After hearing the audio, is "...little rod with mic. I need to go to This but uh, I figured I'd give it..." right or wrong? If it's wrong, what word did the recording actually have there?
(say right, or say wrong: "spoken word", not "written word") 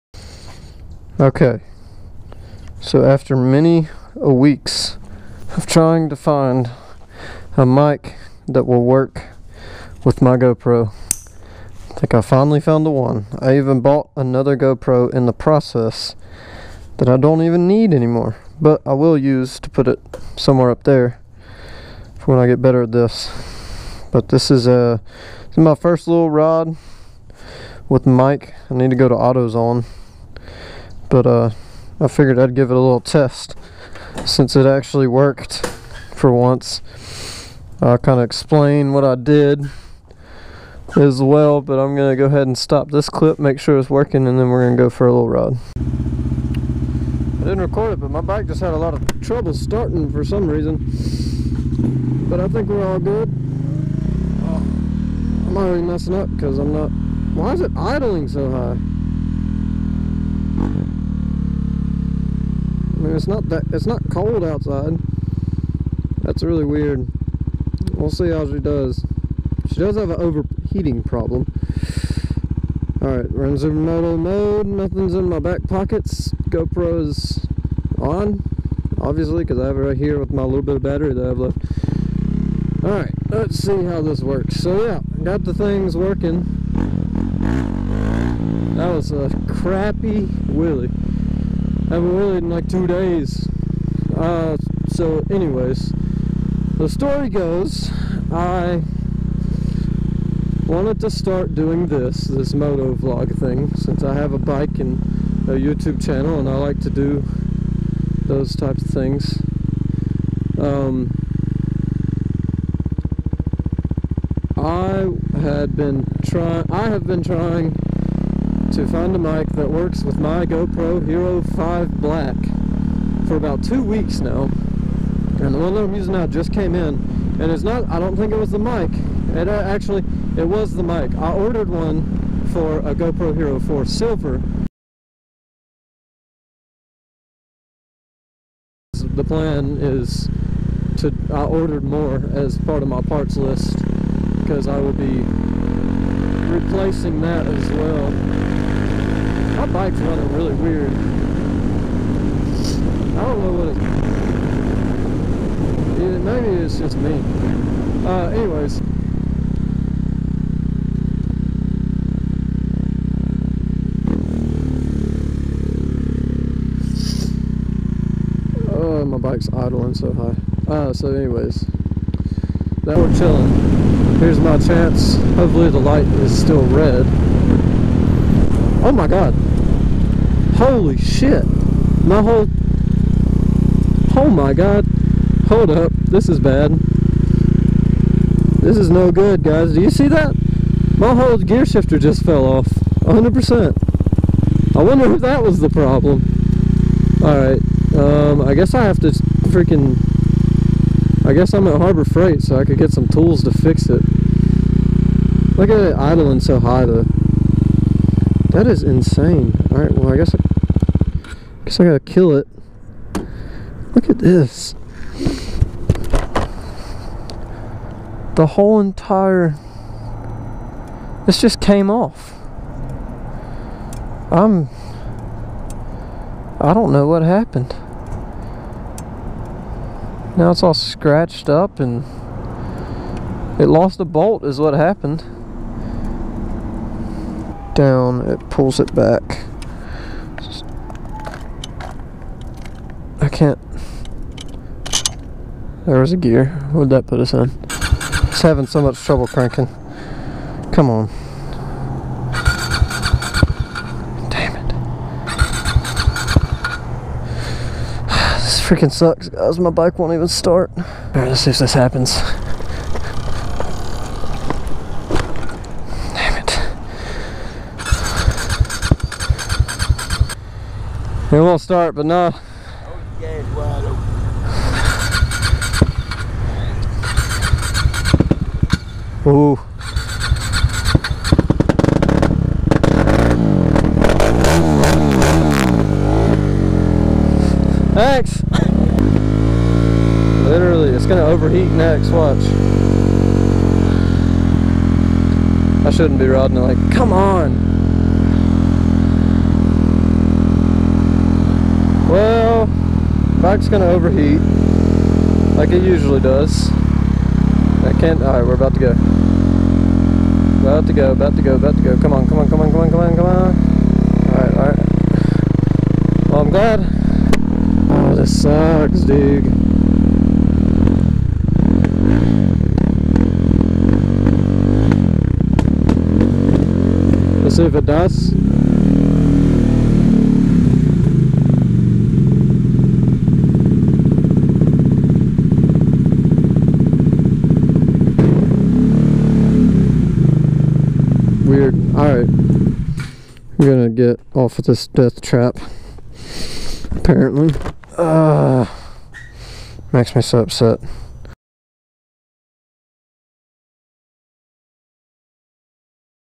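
wrong: "AutoZone", not "This".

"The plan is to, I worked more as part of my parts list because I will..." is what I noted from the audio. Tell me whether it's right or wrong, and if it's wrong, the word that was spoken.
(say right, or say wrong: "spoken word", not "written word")
wrong: "ordered", not "worked".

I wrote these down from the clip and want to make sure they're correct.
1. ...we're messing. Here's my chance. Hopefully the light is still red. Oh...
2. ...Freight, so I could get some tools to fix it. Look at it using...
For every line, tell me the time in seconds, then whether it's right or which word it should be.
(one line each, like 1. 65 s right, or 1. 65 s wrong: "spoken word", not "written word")
1. 172 s wrong: "chilling", not "messing"
2. 202 s wrong: "idling", not "using".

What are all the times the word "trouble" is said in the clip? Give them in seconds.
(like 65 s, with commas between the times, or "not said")
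49 s, 249 s.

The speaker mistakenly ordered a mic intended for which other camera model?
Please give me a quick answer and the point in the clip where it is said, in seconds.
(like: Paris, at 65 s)
GoPro Hero 4 Silver, at 132 s.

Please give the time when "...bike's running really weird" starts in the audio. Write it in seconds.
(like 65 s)
149 s.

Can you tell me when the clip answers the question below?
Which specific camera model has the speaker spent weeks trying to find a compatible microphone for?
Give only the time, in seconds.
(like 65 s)
120 s.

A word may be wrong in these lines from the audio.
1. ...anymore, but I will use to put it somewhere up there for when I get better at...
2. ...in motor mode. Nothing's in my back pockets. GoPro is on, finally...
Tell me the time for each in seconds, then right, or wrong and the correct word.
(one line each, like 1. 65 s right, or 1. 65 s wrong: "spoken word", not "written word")
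1. 17 s right
2. 73 s wrong: "obviously", not "finally".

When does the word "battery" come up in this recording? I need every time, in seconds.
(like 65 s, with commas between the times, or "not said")
80 s.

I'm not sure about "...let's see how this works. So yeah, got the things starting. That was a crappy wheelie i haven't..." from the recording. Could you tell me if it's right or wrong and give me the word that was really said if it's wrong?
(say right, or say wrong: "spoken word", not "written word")
wrong: "working", not "starting".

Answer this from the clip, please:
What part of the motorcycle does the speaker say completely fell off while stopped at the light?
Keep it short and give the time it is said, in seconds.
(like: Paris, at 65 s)
Gear shifter, at 191 s.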